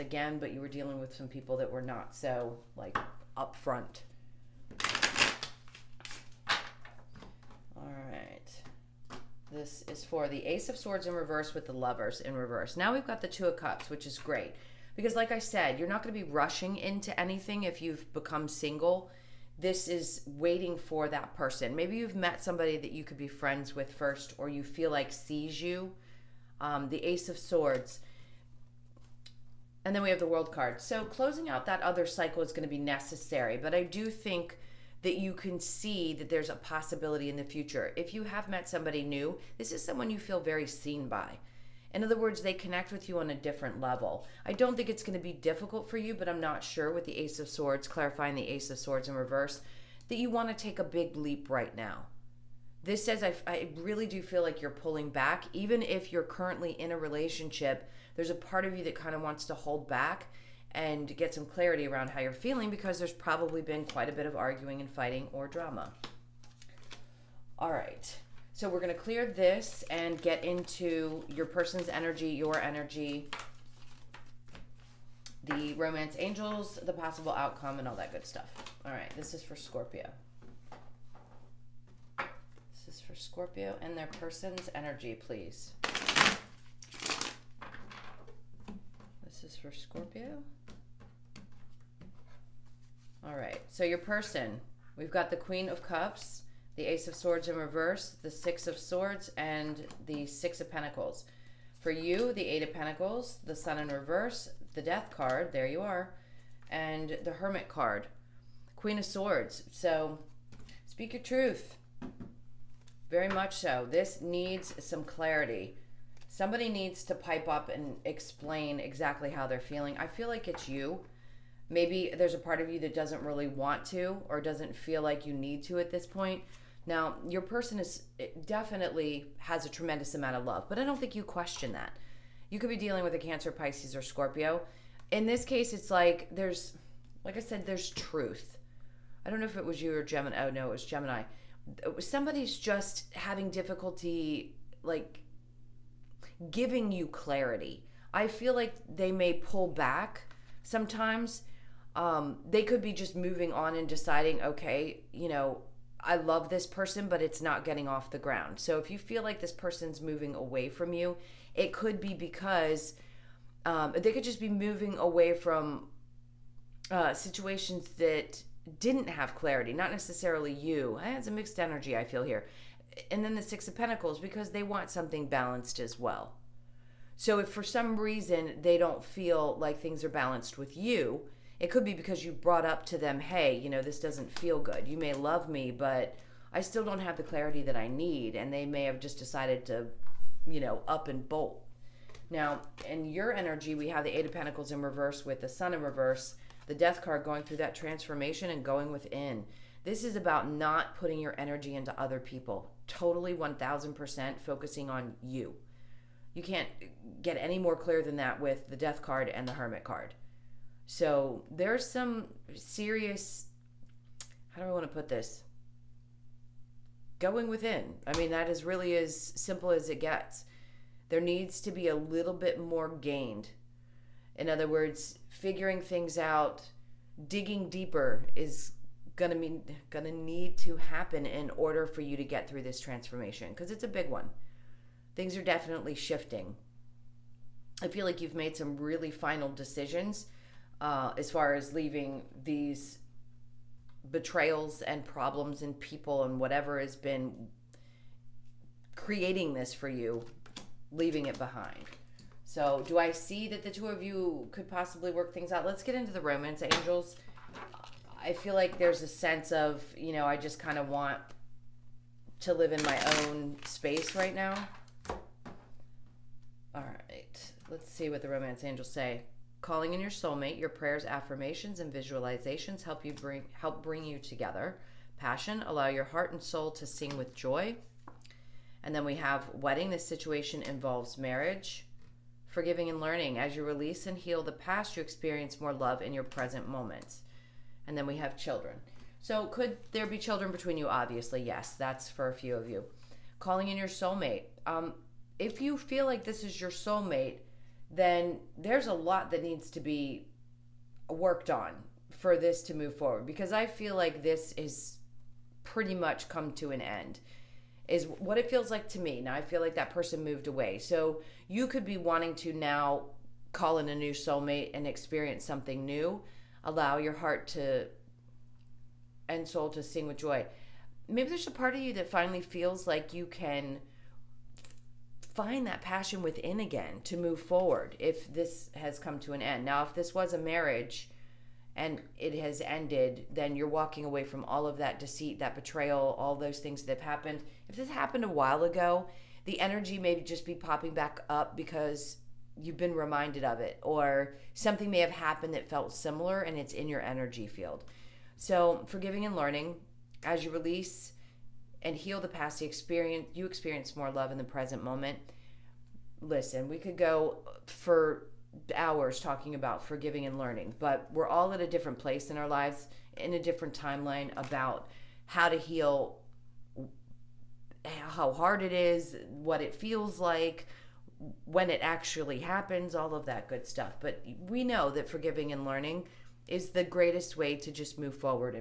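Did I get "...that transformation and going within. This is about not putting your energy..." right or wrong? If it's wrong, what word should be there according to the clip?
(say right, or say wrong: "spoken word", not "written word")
right.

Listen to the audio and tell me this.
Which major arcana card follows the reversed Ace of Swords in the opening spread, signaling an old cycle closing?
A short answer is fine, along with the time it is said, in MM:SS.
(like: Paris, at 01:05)
The World, at 00:30.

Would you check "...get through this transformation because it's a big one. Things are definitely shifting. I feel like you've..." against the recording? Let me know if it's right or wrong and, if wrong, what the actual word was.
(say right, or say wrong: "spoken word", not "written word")
right.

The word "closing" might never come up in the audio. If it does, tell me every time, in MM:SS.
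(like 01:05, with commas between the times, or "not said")
00:31.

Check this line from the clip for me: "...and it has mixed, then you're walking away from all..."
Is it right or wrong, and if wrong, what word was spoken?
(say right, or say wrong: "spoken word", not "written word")
wrong: "ended", not "mixed".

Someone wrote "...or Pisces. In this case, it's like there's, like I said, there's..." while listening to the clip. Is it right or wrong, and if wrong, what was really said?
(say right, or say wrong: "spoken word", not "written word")
wrong: "Scorpio", not "Pisces".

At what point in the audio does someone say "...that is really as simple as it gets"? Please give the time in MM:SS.
03:38.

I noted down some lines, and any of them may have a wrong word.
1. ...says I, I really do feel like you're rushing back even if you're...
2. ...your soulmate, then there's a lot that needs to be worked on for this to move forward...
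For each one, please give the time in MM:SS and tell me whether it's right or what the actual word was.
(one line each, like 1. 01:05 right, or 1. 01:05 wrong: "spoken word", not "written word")
1. 00:53 wrong: "pulling", not "rushing"
2. 04:56 right.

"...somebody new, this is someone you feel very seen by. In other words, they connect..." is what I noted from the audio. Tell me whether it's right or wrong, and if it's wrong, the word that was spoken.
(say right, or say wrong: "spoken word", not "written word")
right.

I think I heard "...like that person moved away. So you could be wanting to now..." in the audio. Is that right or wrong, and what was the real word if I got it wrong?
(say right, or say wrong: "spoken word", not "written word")
right.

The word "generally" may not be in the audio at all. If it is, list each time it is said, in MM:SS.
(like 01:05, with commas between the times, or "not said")
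not said.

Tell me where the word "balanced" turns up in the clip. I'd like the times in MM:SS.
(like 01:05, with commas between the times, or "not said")
02:55, 03:00.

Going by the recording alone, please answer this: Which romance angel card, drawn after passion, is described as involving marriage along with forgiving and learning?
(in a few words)
Wedding.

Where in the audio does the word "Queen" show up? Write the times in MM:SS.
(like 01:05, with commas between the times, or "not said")
01:35, 01:48.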